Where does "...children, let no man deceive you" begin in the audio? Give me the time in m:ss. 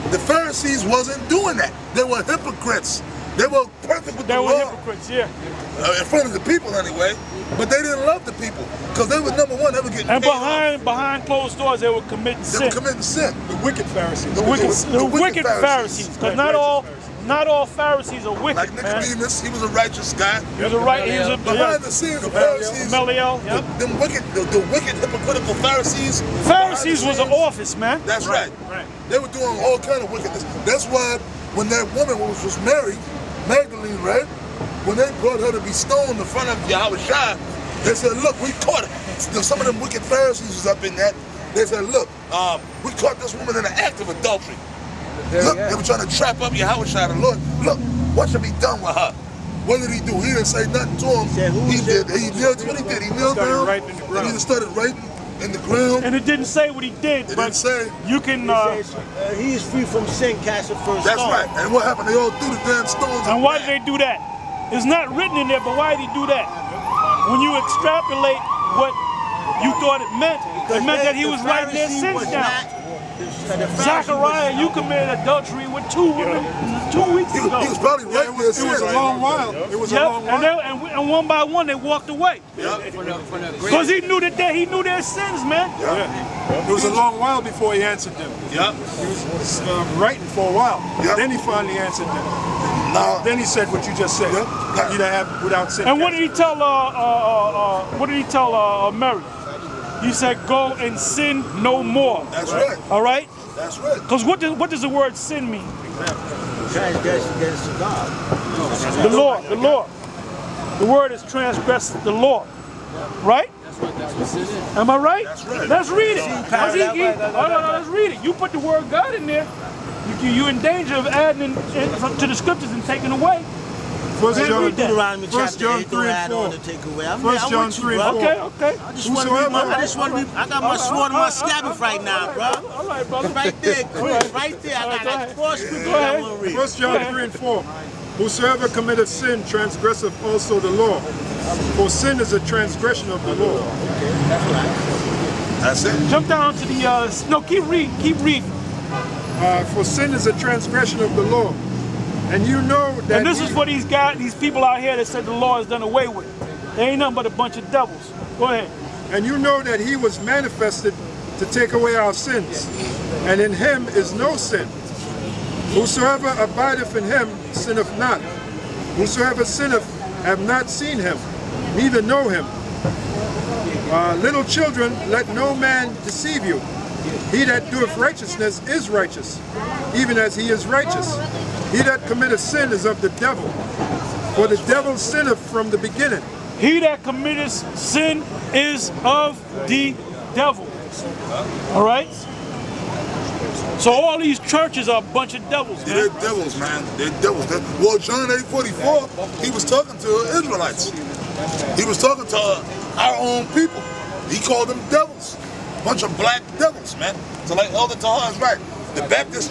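2:54.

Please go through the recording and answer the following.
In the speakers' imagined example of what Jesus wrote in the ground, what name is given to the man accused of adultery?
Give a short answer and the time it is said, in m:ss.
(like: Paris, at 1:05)
Zachariah, at 1:13.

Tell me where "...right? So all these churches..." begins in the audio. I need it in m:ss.
3:11.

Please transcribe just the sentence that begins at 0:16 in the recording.
Pharisees not all Pharisees are wicked, Like Nicodemus, man.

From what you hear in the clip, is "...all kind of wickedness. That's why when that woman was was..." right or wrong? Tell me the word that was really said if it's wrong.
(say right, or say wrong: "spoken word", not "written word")
right.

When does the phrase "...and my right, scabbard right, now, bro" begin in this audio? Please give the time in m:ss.
2:11.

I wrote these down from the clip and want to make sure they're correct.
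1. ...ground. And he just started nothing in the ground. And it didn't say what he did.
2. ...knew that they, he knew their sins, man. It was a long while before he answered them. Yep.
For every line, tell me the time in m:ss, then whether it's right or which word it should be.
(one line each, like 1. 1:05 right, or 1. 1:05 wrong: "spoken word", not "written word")
1. 0:54 wrong: "writing", not "nothing"
2. 1:24 right.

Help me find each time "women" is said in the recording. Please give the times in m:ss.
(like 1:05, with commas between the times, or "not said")
1:16.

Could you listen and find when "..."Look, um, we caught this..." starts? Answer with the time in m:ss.
0:41.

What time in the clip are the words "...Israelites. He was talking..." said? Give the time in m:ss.
3:20.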